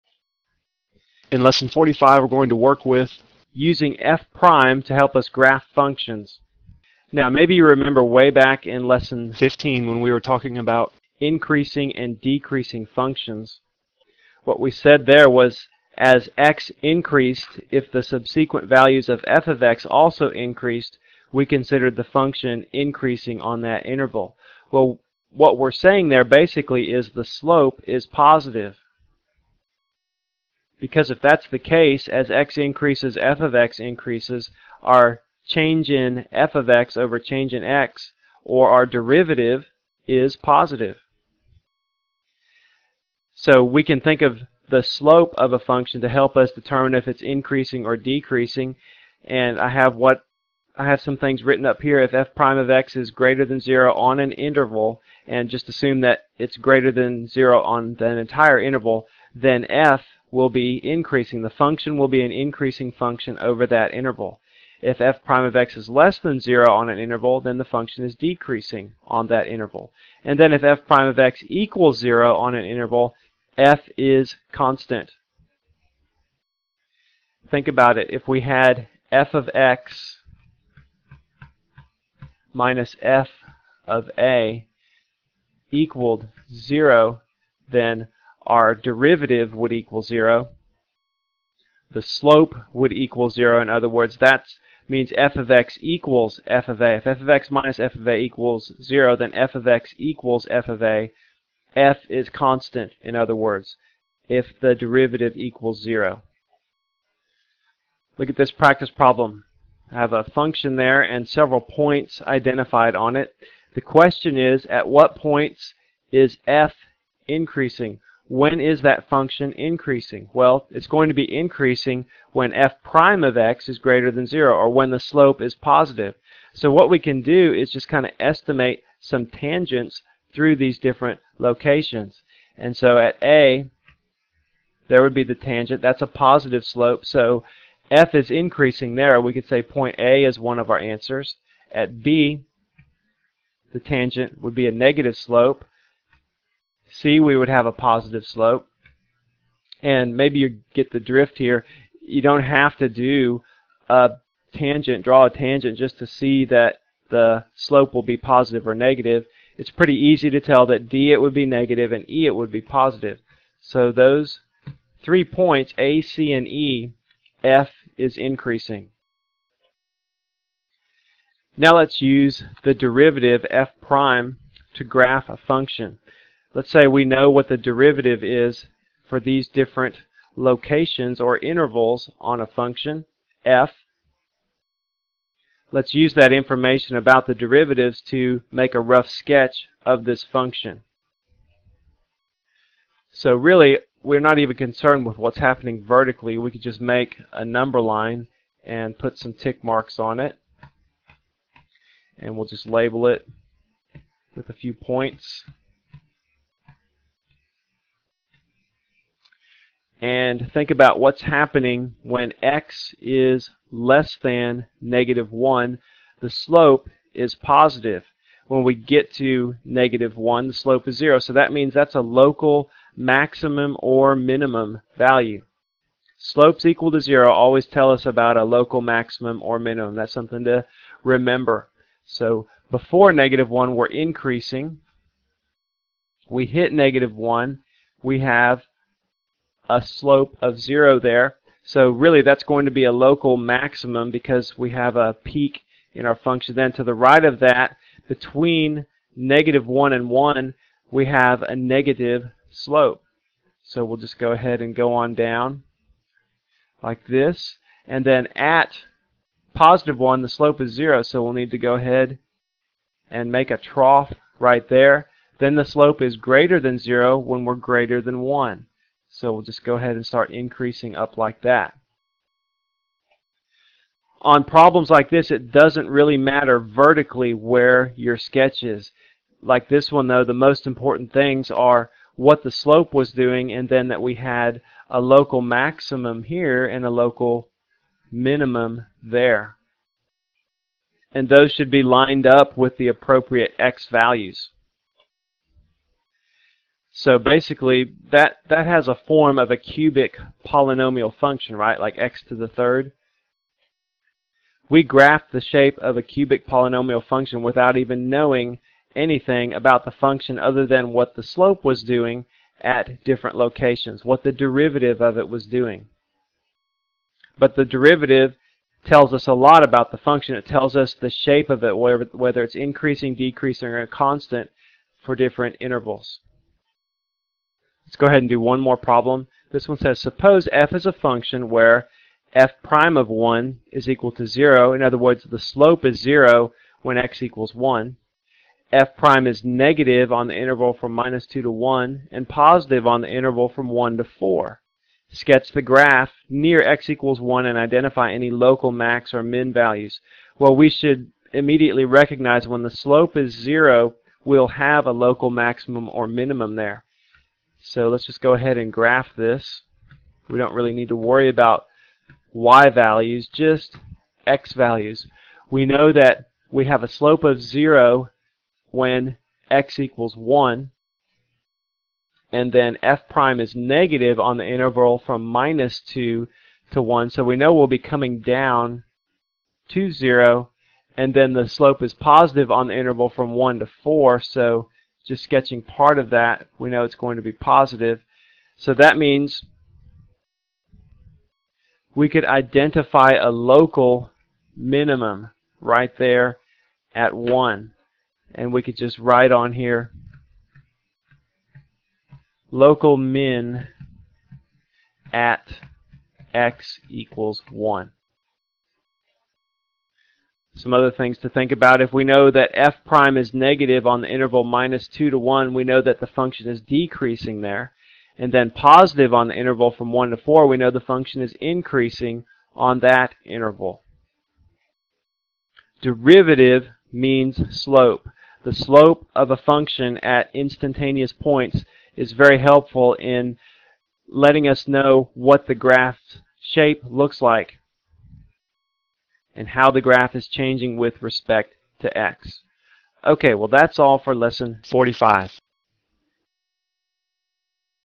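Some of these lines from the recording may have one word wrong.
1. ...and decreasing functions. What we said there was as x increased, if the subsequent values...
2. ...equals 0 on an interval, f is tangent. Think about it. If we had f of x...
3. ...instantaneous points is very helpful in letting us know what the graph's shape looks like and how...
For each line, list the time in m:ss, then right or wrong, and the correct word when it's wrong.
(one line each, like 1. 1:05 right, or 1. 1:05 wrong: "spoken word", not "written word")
1. 0:11 right
2. 1:11 wrong: "constant", not "tangent"
3. 7:10 right.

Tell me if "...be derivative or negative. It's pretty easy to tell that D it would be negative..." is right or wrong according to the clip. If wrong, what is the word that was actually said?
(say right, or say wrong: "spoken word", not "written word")
wrong: "positive", not "derivative".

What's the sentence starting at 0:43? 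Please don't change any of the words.
So we can think of the slope of a function to help us determine if it's increasing or decreasing.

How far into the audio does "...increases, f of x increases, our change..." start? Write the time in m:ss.
0:32.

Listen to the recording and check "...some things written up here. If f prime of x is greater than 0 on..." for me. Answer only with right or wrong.
right.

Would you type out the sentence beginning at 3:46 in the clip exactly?
Slopes equal to 0 always tell us about a local maximum or minimum.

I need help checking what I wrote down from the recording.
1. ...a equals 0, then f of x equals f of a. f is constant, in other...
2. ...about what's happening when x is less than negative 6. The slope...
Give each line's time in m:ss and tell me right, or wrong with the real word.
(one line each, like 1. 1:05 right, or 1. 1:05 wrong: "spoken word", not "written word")
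1. 1:38 right
2. 3:30 wrong: "1", not "6".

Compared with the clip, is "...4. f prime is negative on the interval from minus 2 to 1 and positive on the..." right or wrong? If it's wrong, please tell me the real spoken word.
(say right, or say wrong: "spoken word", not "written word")
wrong: "1", not "4".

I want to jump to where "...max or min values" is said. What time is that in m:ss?
5:48.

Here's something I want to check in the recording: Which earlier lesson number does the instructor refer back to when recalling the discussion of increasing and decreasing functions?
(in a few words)
15.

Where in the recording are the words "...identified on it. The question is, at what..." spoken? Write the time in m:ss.
1:52.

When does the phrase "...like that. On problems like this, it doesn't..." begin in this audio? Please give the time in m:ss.
4:31.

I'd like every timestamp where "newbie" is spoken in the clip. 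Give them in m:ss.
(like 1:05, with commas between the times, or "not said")
not said.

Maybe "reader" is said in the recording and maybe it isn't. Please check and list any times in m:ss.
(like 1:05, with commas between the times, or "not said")
not said.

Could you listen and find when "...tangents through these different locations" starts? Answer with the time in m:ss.
2:09.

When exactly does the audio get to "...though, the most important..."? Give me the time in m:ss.
4:40.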